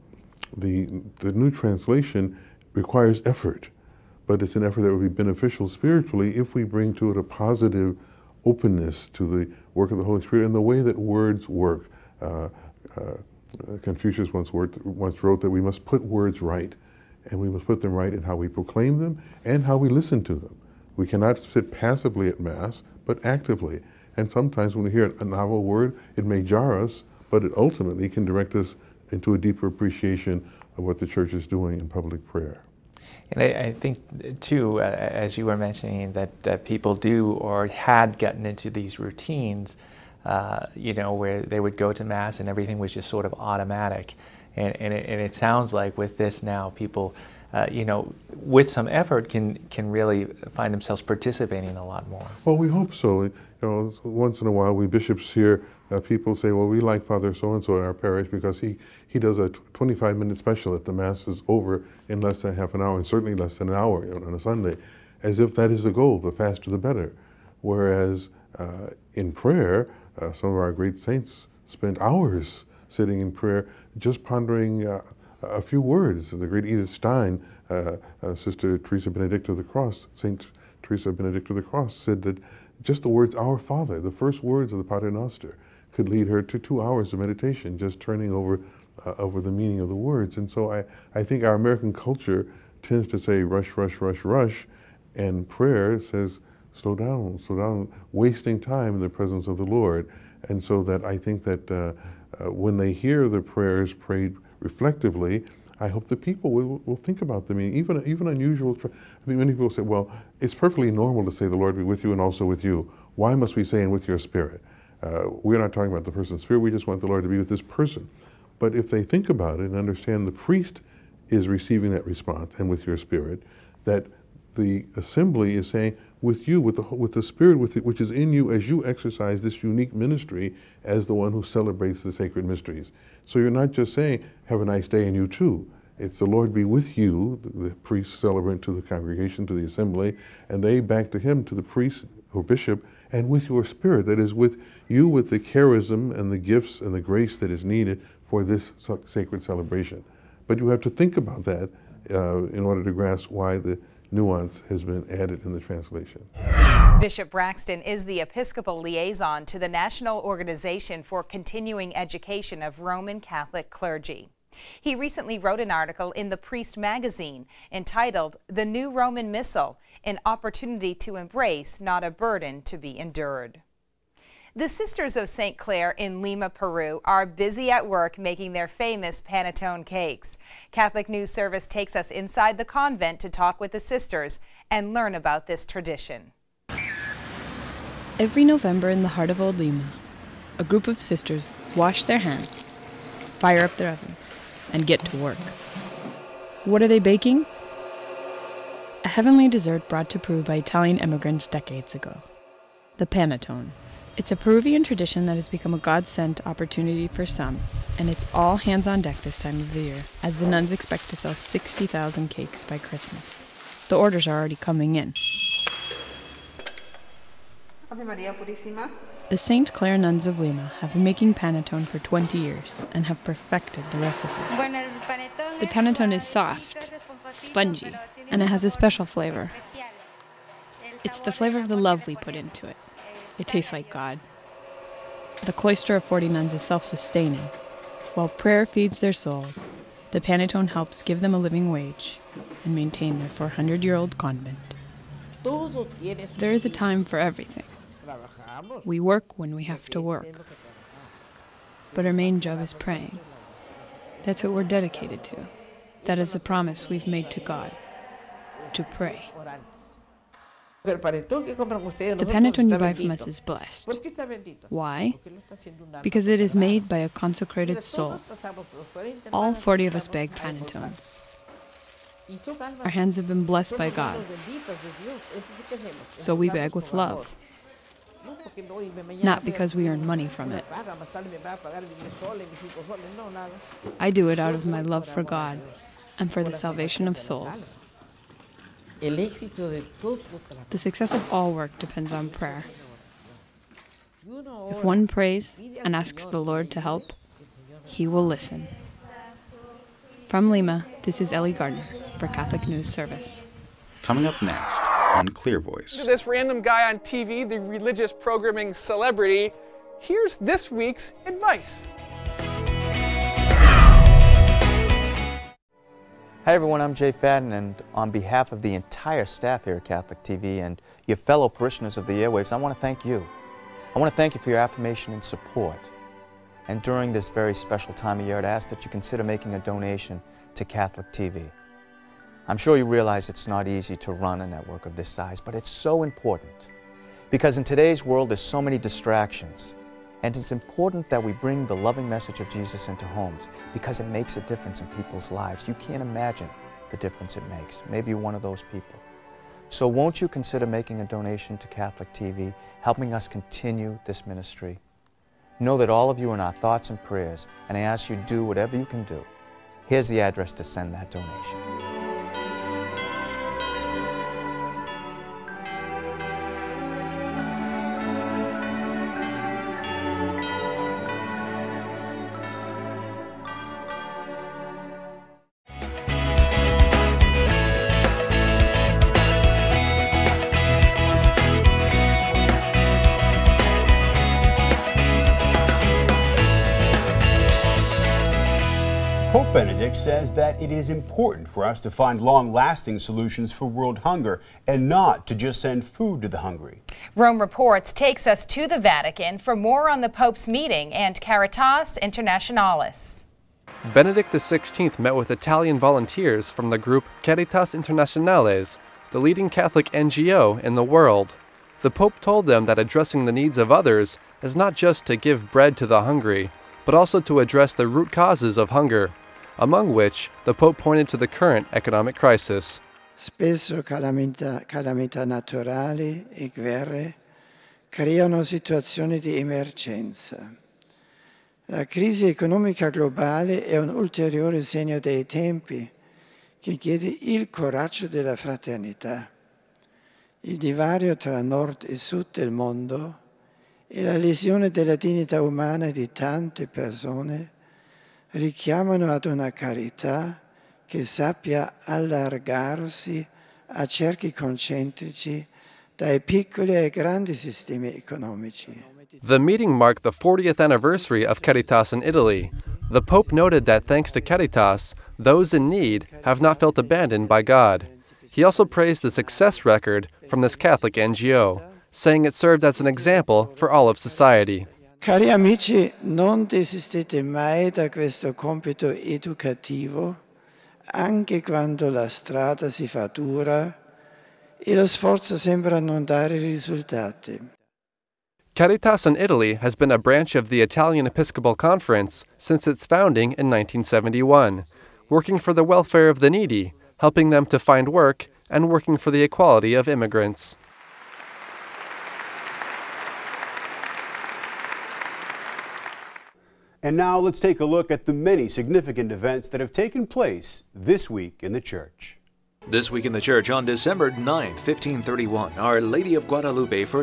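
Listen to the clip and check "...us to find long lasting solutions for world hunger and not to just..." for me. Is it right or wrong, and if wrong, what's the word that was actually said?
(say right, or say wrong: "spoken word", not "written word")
right.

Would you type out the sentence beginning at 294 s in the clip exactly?
If one prays and asks the Lord to help, He will listen.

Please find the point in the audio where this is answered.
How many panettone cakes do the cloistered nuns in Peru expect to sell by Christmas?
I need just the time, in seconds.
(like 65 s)
211 s.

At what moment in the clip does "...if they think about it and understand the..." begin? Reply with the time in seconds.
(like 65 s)
118 s.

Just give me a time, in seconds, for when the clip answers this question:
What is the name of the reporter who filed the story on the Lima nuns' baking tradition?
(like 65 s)
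301 s.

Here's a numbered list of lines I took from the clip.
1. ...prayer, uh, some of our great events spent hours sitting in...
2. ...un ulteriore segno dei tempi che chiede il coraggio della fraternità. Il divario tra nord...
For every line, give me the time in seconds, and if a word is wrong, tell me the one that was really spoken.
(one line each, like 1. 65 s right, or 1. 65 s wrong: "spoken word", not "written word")
1. 69 s wrong: "saints", not "events"
2. 433 s right.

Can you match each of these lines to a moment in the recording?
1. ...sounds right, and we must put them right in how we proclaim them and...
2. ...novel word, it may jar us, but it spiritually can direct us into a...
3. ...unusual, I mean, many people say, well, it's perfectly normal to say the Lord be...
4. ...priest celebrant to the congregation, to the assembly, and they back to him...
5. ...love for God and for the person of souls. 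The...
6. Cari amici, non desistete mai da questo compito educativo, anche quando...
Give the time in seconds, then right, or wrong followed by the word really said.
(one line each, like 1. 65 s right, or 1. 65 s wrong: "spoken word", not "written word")
1. 16 s wrong: "words", not "sounds"
2. 25 s wrong: "ultimately", not "spiritually"
3. 108 s right
4. 137 s right
5. 284 s wrong: "salvation", not "person"
6. 475 s right.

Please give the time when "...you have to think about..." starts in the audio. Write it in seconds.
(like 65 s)
150 s.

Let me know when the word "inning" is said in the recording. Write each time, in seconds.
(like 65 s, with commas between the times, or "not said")
not said.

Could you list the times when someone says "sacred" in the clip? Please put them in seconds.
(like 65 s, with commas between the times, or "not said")
132 s, 149 s.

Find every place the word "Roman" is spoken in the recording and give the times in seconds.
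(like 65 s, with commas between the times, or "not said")
162 s, 168 s.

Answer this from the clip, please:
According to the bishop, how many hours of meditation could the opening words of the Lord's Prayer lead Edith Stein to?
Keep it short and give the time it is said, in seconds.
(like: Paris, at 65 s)
2, at 86 s.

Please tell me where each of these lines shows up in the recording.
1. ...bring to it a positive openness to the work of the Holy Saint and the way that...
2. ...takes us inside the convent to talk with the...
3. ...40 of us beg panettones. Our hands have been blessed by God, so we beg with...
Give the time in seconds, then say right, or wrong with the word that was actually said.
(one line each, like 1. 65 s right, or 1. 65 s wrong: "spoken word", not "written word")
1. 6 s wrong: "Spirit", not "Saint"
2. 181 s right
3. 269 s right.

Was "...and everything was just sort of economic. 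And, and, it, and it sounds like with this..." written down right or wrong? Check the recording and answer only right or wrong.
wrong.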